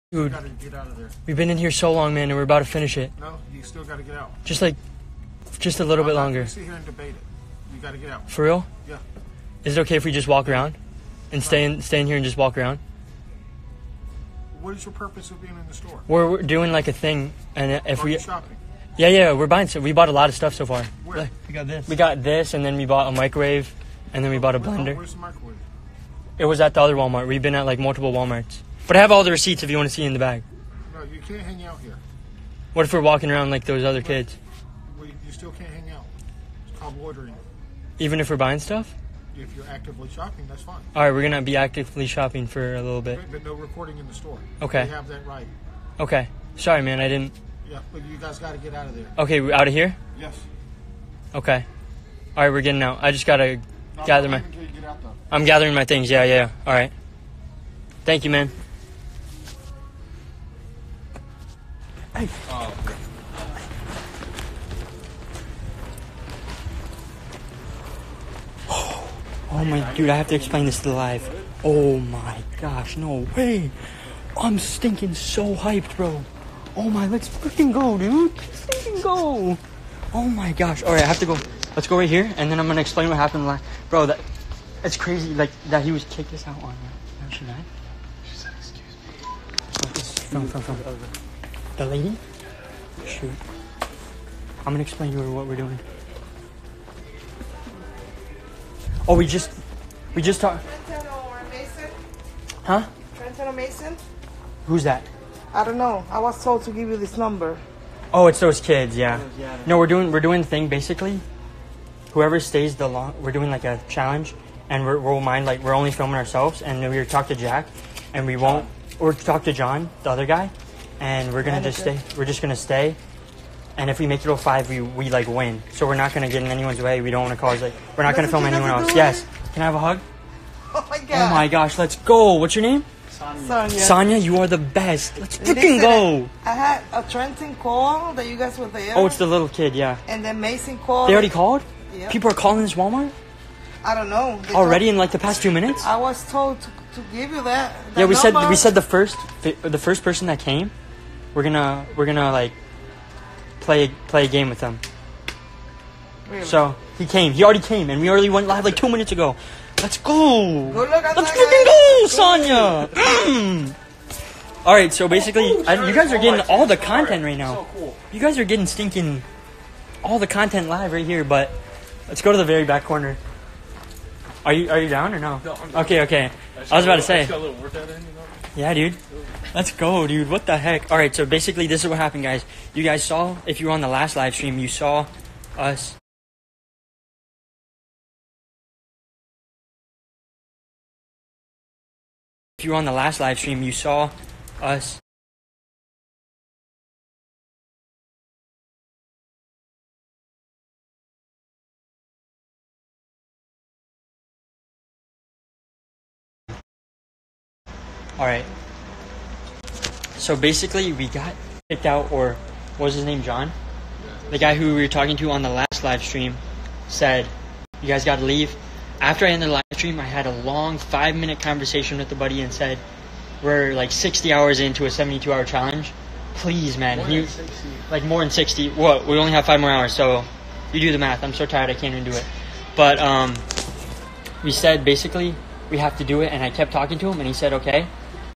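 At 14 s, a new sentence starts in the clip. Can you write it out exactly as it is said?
What is your purpose of being in the store?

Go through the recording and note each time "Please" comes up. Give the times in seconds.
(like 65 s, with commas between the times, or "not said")
226 s.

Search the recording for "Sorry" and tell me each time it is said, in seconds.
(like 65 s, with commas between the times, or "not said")
46 s.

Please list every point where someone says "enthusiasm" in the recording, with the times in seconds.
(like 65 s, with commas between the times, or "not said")
not said.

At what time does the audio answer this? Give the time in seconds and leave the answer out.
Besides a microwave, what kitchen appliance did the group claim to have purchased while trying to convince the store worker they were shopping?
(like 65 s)
24 s.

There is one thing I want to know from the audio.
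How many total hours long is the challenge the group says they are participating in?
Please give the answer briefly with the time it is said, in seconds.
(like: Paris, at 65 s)
72, at 224 s.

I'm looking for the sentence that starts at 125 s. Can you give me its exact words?
So we're not gonna get in anyone's way.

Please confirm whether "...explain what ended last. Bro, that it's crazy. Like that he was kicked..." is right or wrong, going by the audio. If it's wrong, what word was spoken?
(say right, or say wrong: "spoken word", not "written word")
wrong: "happened", not "ended".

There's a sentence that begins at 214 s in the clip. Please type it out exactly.
The guy who we were talking to on the last live stream said, You guys got to leave.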